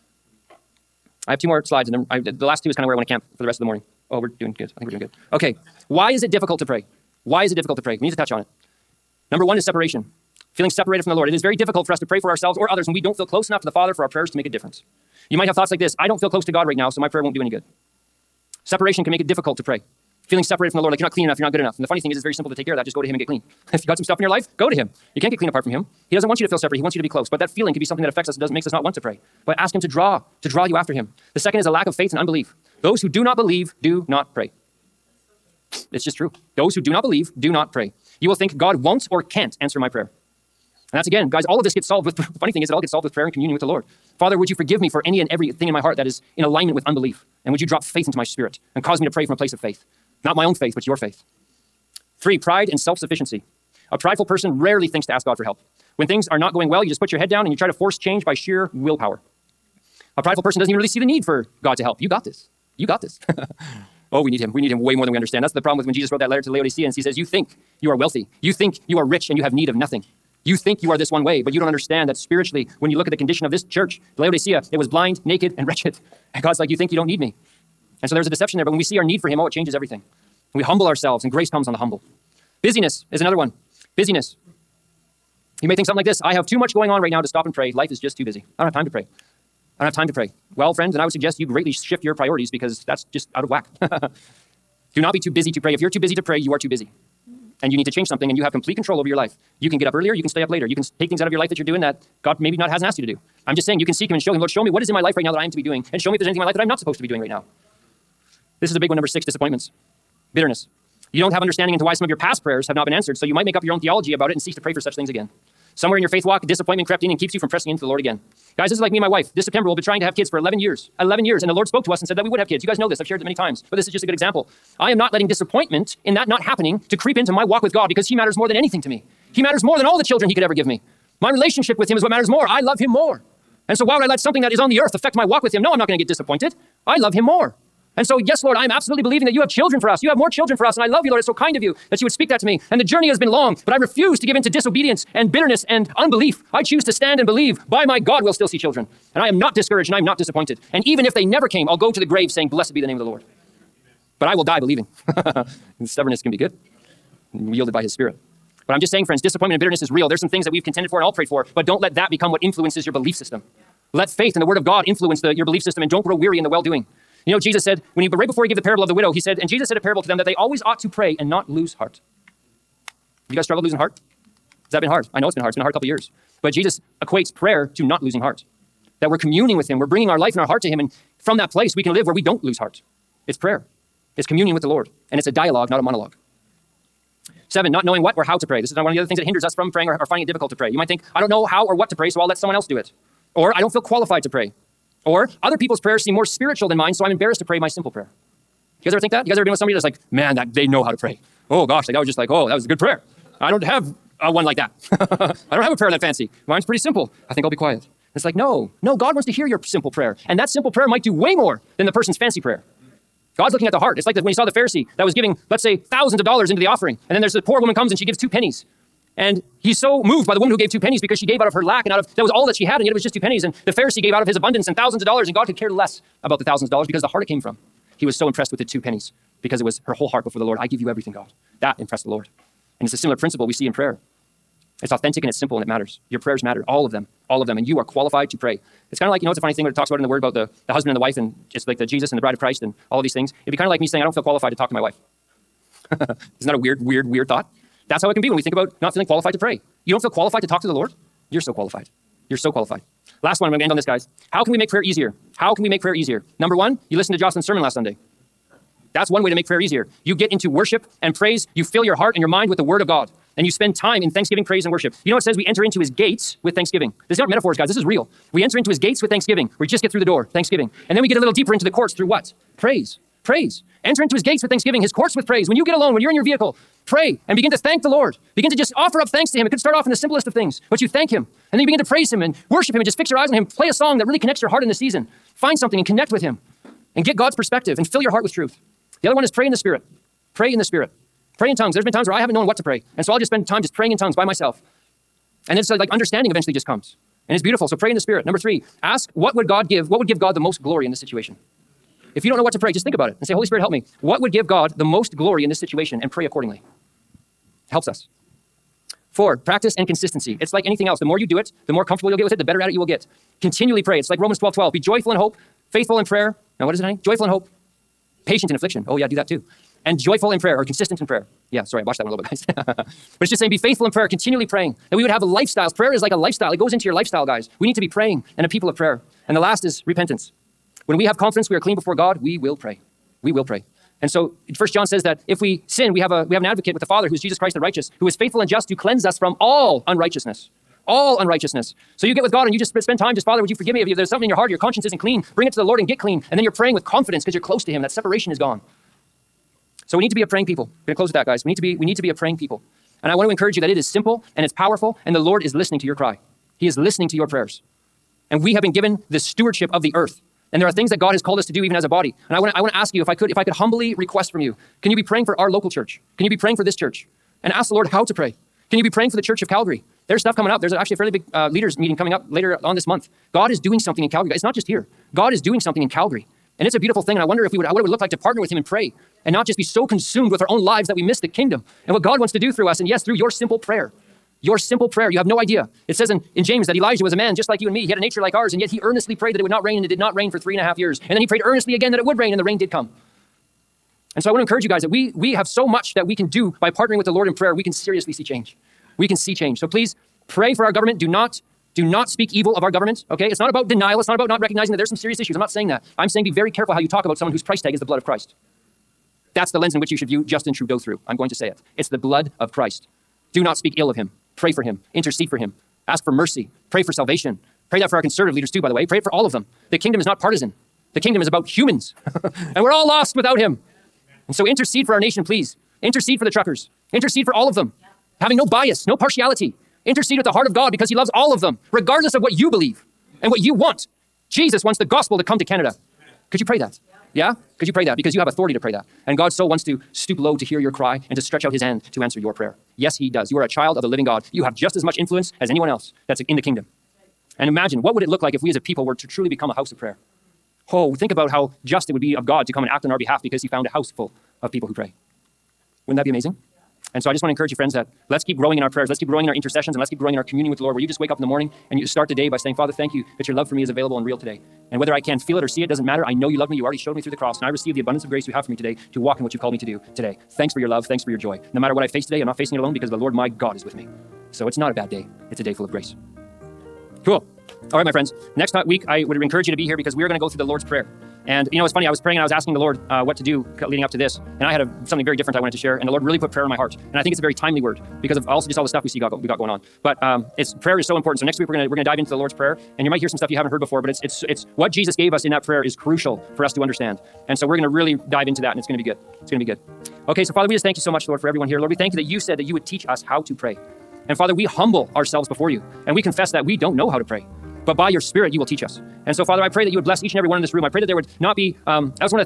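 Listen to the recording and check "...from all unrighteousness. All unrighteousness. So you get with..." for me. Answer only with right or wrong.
right.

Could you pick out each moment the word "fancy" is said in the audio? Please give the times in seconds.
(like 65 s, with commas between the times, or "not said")
206 s, 212 s.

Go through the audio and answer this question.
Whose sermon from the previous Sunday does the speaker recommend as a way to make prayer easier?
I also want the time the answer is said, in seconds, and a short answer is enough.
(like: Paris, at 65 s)
Jocelyn, at 257 s.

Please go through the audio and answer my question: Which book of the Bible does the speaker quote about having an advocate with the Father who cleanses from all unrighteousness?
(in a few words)
First John.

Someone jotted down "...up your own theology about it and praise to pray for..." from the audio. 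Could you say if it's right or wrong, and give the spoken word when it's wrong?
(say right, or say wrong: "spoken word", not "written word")
wrong: "cease", not "praise".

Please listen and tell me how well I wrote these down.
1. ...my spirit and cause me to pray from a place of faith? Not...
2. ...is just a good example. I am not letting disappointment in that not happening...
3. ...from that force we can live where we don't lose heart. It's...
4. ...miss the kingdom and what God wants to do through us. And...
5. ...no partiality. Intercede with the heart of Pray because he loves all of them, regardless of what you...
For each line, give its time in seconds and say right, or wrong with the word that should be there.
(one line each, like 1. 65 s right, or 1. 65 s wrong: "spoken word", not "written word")
1. 48 s right
2. 123 s right
3. 181 s wrong: "place", not "force"
4. 381 s right
5. 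428 s wrong: "God", not "Pray".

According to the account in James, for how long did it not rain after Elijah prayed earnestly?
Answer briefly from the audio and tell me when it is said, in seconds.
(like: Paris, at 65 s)
3.5 years, at 390 s.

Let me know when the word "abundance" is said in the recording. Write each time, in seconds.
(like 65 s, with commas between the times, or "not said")
224 s, 467 s.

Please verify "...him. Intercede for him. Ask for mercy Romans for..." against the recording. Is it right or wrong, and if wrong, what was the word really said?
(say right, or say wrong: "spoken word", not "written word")
wrong: "Pray", not "Romans".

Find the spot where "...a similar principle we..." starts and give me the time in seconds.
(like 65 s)
232 s.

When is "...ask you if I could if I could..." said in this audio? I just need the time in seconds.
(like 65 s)
362 s.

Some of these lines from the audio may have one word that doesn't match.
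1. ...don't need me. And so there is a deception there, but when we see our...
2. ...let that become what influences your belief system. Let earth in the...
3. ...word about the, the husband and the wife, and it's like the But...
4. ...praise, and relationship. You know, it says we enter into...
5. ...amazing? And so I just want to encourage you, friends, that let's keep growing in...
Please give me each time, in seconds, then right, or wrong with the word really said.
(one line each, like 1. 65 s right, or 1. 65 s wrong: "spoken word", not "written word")
1. 76 s right
2. 161 s wrong: "faith", not "earth"
3. 240 s wrong: "Jesus", not "But"
4. 264 s wrong: "worship", not "relationship"
5. 456 s right.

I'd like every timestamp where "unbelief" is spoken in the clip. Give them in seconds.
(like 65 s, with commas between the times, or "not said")
32 s, 46 s, 145 s.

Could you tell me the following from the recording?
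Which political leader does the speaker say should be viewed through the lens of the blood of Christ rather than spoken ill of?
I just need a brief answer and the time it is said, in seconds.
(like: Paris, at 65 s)
Justin Trudeau, at 410 s.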